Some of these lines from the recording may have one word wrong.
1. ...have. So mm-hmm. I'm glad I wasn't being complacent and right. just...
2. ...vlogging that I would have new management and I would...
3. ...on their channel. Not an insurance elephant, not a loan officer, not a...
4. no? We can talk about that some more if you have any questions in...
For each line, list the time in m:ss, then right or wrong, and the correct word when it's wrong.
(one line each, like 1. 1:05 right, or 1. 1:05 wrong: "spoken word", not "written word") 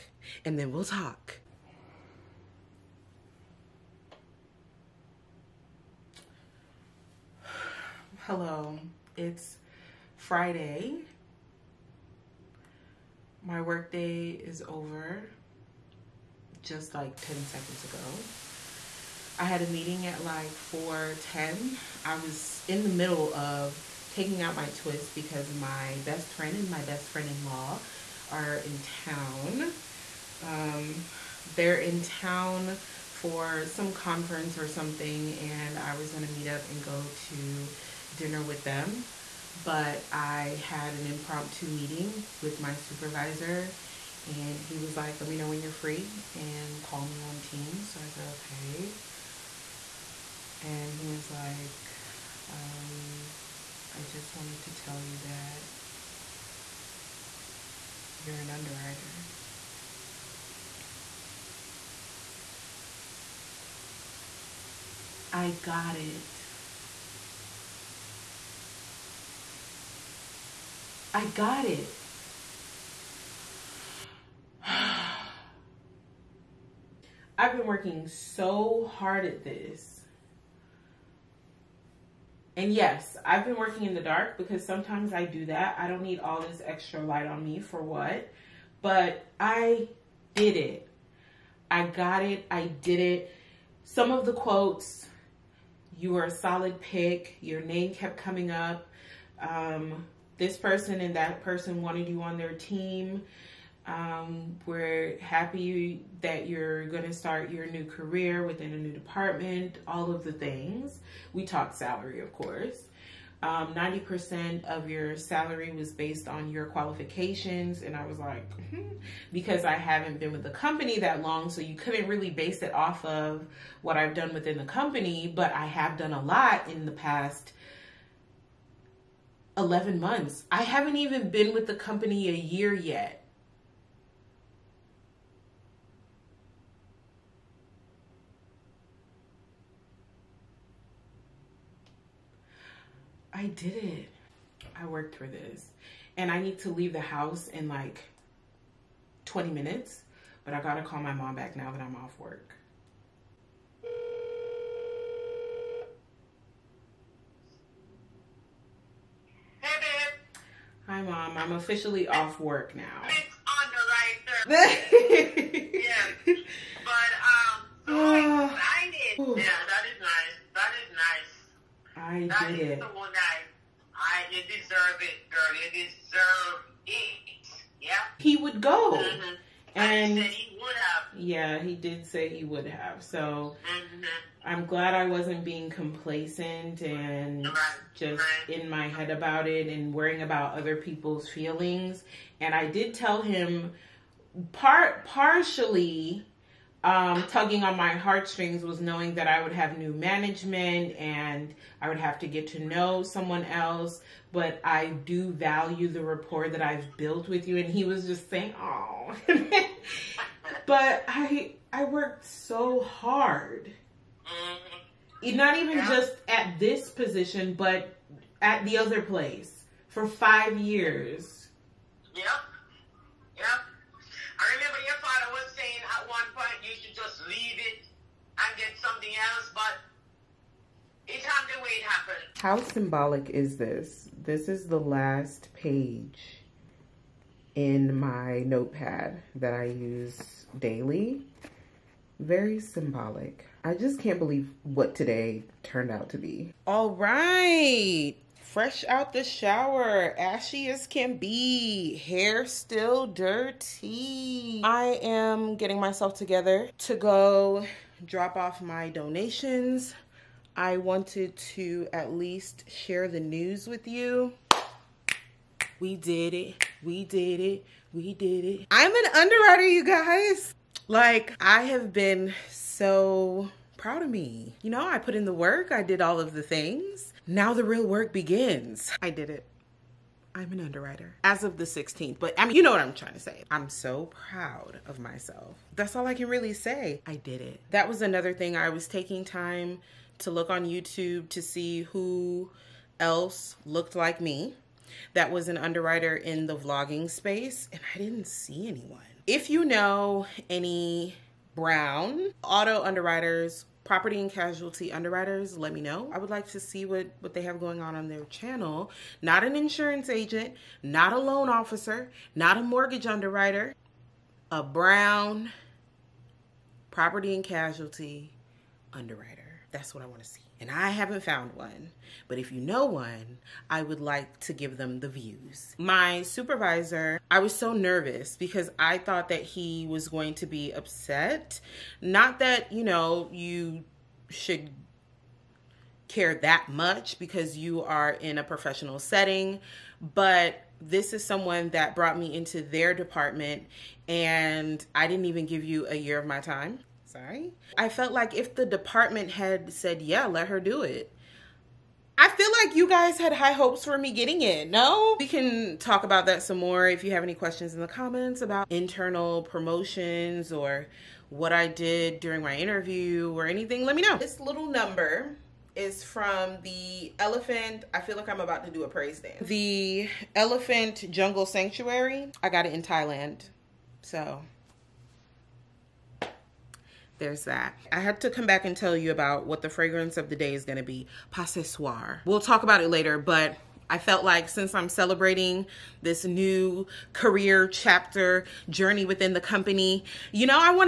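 1. 3:02 right
2. 3:18 wrong: "knowing", not "vlogging"
3. 5:07 wrong: "agent", not "elephant"
4. 5:54 right.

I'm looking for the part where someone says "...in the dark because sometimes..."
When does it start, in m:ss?
1:23.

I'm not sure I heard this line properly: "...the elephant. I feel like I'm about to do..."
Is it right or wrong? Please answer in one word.
right.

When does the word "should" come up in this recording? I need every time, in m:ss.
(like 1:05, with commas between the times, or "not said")
5:34.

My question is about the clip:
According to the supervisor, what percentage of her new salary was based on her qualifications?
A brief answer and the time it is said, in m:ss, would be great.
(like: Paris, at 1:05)
90%, at 1:53.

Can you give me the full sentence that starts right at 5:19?
That's what I want to see and I haven't found one.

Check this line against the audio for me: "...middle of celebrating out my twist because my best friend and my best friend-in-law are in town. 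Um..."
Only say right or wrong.
wrong.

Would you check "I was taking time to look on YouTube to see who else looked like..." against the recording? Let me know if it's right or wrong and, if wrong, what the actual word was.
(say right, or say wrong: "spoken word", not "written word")
right.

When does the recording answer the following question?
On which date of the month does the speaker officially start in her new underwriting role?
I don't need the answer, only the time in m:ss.
4:41.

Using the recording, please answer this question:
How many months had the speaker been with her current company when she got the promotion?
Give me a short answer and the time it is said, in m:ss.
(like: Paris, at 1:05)
11 months, at 2:09.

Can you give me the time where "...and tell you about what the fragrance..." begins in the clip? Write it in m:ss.
6:18.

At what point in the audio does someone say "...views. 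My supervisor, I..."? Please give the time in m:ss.
5:25.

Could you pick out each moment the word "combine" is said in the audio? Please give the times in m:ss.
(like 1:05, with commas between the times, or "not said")
not said.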